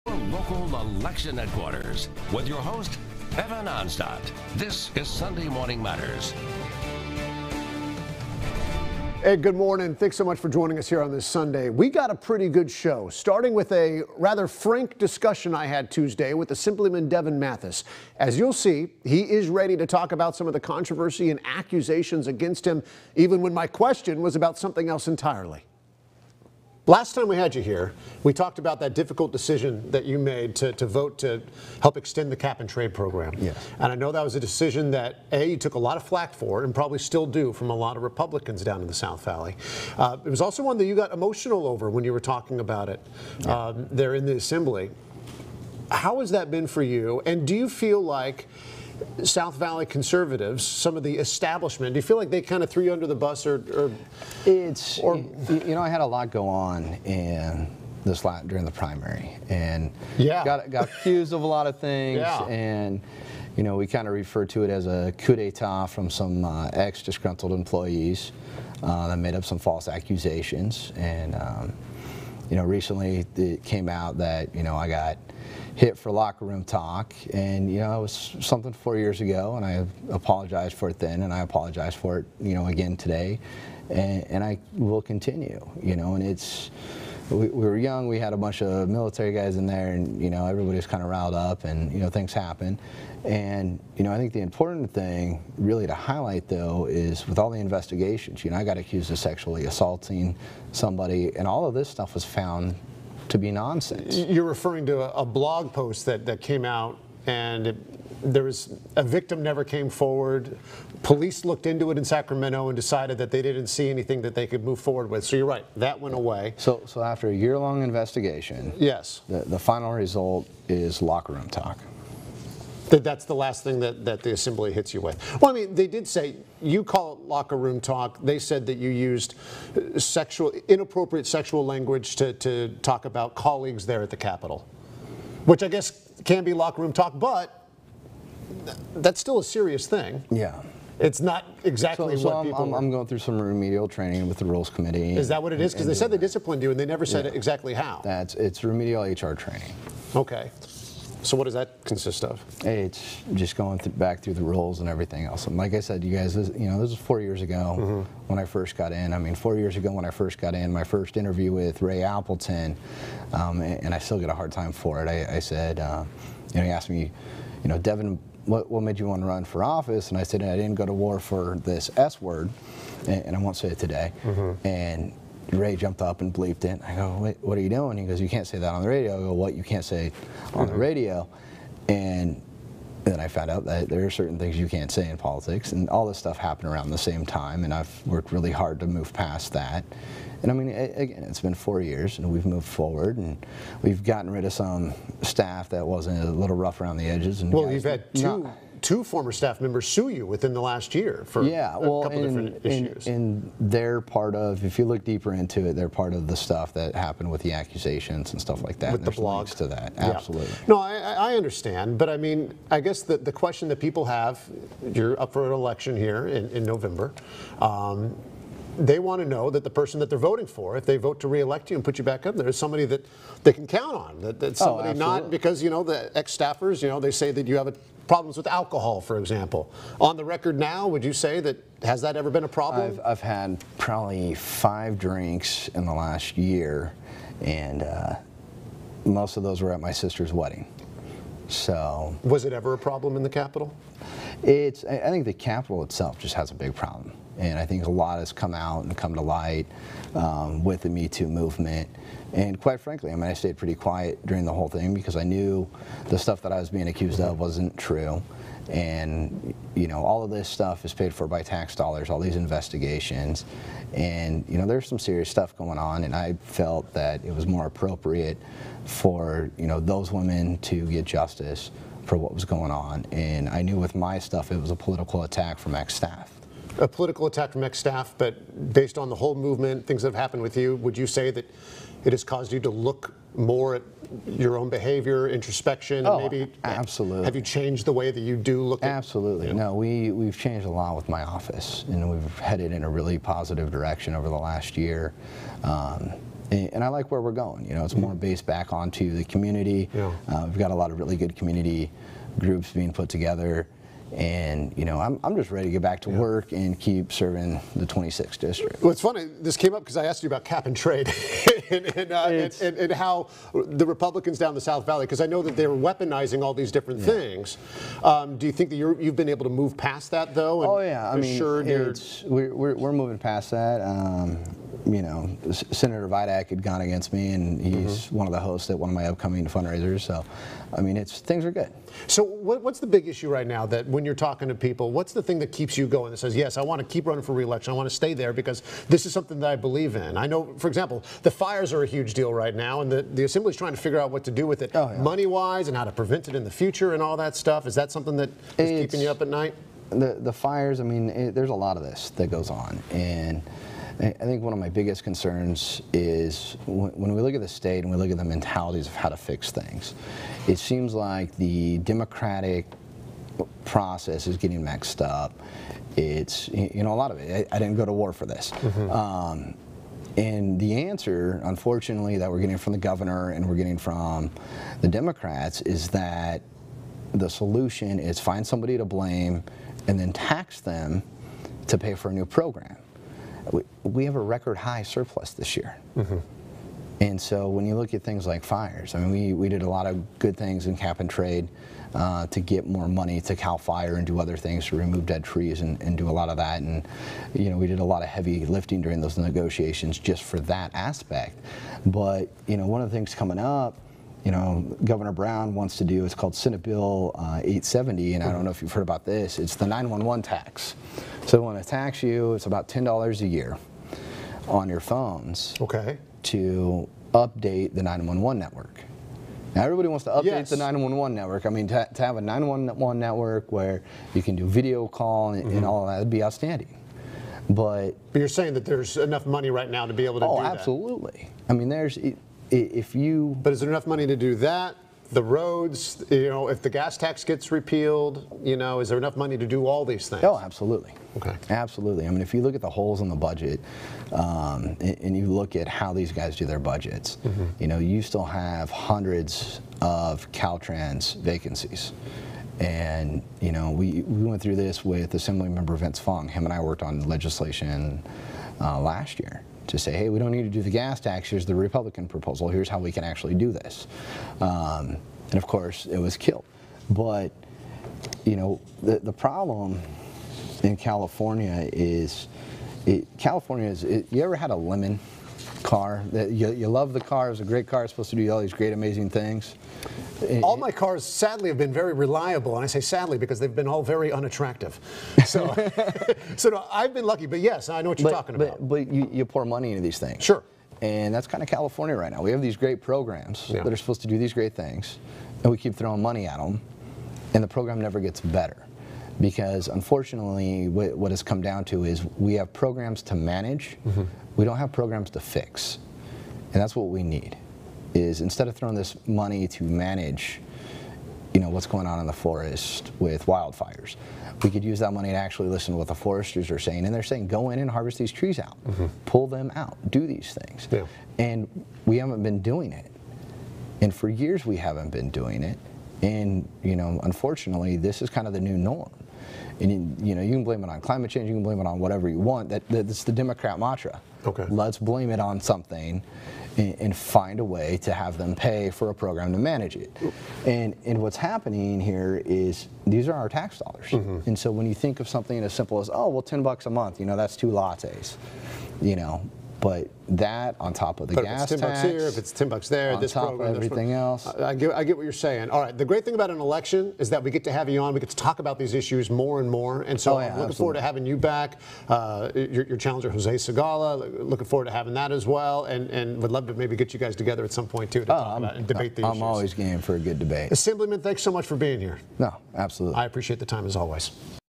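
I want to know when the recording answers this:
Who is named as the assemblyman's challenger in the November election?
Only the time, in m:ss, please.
9:23.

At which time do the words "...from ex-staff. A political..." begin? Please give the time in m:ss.
4:35.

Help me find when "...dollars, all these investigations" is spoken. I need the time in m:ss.
4:21.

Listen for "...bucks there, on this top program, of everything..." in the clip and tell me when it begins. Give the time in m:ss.
9:12.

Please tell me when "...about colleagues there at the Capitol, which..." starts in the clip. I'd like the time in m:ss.
2:13.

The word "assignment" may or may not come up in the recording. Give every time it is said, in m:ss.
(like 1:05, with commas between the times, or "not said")
not said.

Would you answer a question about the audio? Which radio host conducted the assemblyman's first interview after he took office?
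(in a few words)
Ray Appleton.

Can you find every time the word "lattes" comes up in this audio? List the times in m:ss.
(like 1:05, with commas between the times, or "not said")
9:07.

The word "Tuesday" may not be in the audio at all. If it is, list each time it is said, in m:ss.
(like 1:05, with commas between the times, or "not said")
0:15.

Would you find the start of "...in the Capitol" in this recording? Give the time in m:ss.
4:03.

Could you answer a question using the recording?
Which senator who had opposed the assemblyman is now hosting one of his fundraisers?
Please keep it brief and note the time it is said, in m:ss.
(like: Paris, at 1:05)
Senator Vidak, at 5:25.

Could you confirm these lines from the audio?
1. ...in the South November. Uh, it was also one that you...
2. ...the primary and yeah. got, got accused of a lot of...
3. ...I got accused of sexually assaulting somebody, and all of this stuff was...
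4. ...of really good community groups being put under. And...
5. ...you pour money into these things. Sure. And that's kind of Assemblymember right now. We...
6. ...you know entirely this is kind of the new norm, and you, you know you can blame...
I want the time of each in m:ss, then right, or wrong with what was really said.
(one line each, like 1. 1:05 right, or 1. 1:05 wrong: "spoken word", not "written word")
1. 0:38 wrong: "Valley", not "November"
2. 0:58 right
3. 1:38 right
4. 5:00 wrong: "together", not "under"
5. 8:09 wrong: "California", not "Assemblymember"
6. 8:46 wrong: "unfortunately", not "entirely".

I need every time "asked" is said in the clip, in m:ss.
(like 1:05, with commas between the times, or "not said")
2:46, 5:10.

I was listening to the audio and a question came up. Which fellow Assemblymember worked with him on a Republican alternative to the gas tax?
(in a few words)
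Vince Fong.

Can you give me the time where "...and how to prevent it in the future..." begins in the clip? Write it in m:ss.
5:45.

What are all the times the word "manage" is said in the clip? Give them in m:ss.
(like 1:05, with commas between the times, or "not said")
8:23, 8:29, 8:59.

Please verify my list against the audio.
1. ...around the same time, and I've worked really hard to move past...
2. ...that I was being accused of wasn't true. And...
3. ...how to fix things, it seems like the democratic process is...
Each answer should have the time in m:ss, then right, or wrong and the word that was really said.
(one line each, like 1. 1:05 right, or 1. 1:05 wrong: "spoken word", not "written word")
1. 3:06 right
2. 4:16 right
3. 5:58 right.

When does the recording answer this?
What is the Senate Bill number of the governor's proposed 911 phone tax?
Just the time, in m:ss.
6:47.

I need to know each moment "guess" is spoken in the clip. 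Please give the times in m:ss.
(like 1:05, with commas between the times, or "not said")
2:15, 3:32.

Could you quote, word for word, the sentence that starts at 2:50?
And I said, I didn't go to war for this S word, and, and I won't say it today.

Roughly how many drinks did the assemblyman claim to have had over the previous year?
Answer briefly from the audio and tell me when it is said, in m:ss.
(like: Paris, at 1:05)
5, at 3:54.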